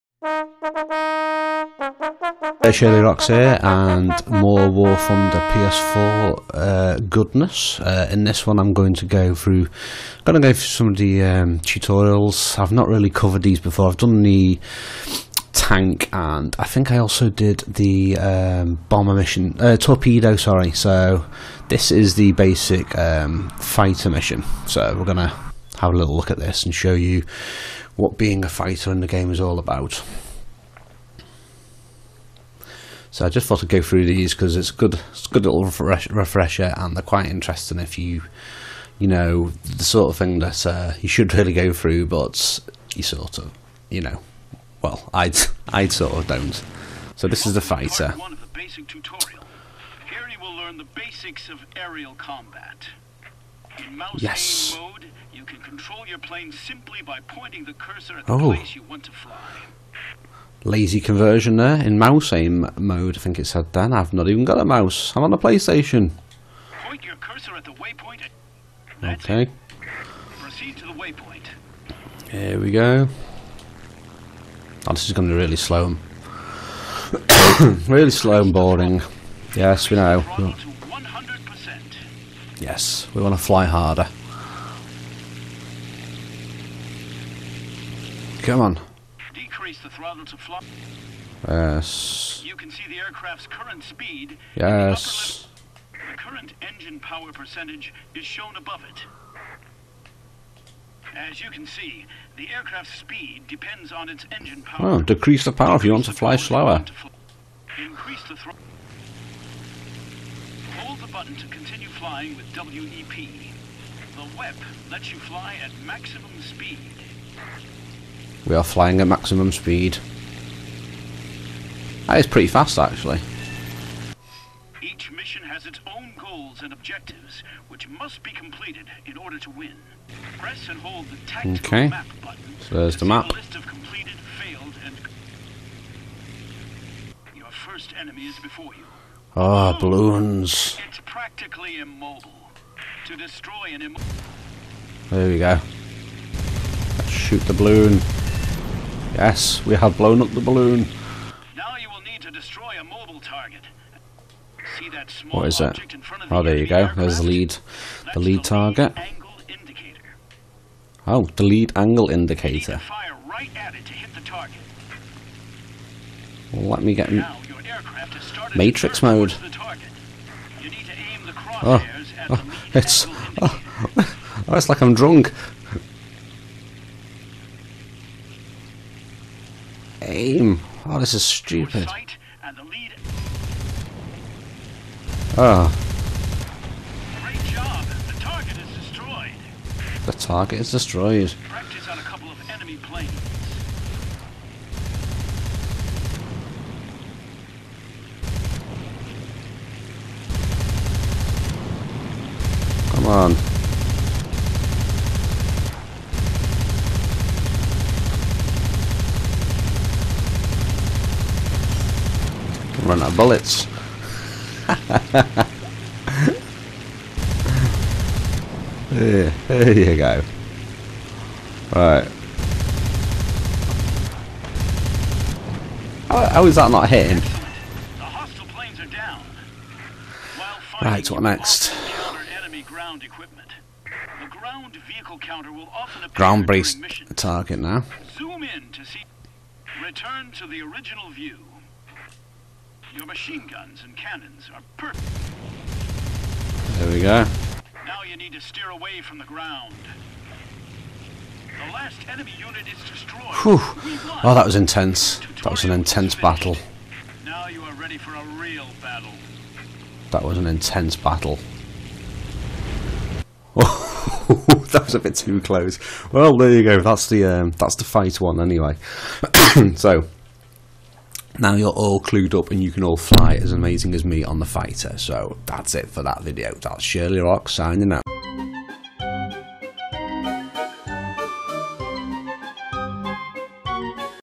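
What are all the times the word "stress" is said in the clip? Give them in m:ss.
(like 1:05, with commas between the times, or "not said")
not said.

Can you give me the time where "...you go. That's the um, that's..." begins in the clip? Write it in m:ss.
4:26.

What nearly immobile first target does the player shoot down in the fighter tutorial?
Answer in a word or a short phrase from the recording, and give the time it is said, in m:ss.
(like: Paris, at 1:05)
Balloons, at 2:19.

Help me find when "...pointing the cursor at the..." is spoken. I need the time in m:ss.
0:57.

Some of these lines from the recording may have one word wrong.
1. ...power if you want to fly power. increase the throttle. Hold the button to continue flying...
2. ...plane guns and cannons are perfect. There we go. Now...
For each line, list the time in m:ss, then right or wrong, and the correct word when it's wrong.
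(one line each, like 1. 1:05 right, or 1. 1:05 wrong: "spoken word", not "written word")
1. 1:45 wrong: "slower", not "power"
2. 4:03 wrong: "machine", not "plane".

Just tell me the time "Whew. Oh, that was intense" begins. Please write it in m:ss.
4:13.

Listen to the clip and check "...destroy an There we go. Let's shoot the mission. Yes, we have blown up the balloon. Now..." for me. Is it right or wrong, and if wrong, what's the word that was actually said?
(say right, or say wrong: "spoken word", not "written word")
wrong: "balloon", not "mission".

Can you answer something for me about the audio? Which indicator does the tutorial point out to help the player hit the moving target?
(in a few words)
Lead angle indicator.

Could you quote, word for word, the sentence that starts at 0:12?
I've not really covered these before.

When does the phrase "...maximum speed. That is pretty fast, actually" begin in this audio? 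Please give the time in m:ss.
1:59.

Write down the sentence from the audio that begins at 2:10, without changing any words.
Press and hold the tactical okay.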